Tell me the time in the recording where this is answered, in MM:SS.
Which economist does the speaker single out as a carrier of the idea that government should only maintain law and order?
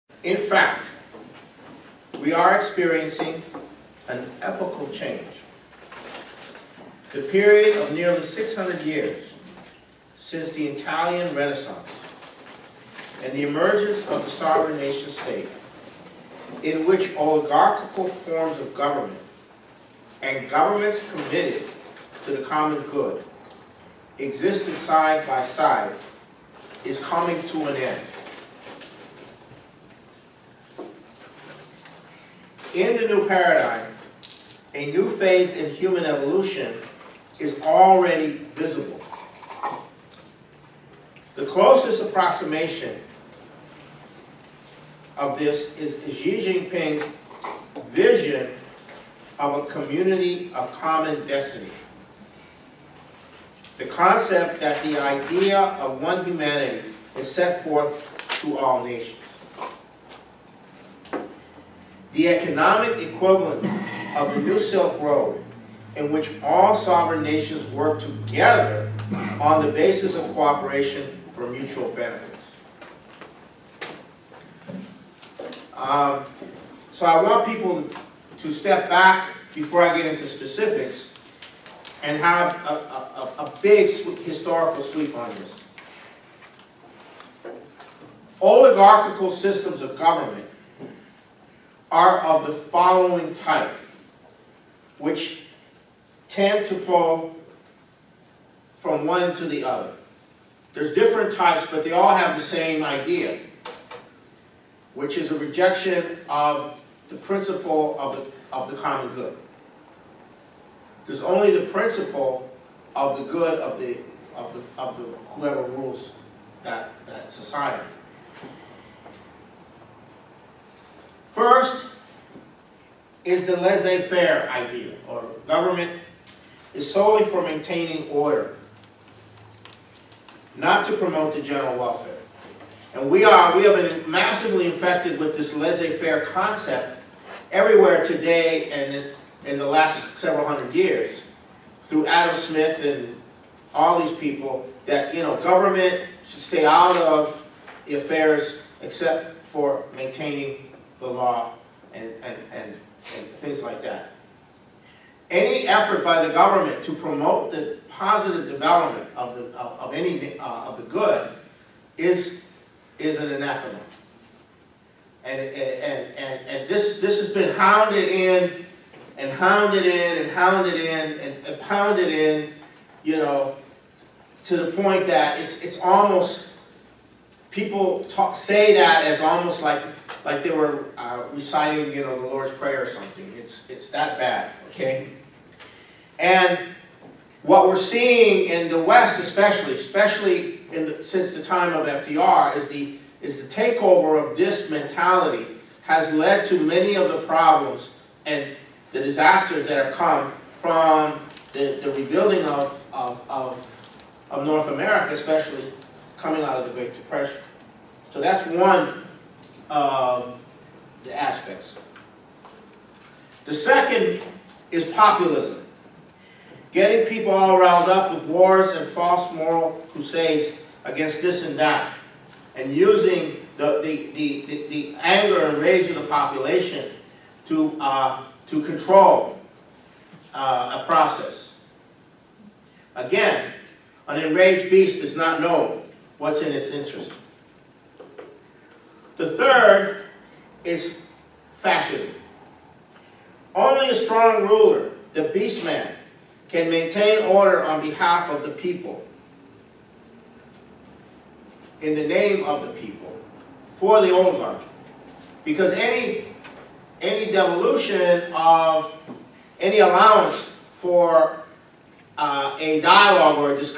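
02:22.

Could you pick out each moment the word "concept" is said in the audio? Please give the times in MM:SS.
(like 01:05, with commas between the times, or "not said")
00:53, 02:16.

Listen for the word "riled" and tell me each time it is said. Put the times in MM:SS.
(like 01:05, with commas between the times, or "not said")
03:37.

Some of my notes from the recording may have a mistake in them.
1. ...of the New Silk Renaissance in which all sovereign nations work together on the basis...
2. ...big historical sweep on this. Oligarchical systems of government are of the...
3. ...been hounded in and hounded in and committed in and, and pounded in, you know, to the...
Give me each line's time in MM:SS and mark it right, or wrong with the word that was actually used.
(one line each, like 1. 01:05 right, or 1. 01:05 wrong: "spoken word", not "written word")
1. 01:04 wrong: "Road", not "Renaissance"
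2. 01:23 right
3. 02:47 wrong: "hounded", not "committed".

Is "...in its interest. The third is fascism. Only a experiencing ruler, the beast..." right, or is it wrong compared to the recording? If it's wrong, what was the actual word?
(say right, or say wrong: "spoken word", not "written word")
wrong: "strong", not "experiencing".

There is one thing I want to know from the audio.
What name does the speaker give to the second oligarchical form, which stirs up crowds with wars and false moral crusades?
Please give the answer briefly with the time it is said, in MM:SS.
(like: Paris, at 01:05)
populism, at 03:34.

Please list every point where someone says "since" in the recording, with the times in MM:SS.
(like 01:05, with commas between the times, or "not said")
00:10, 03:11.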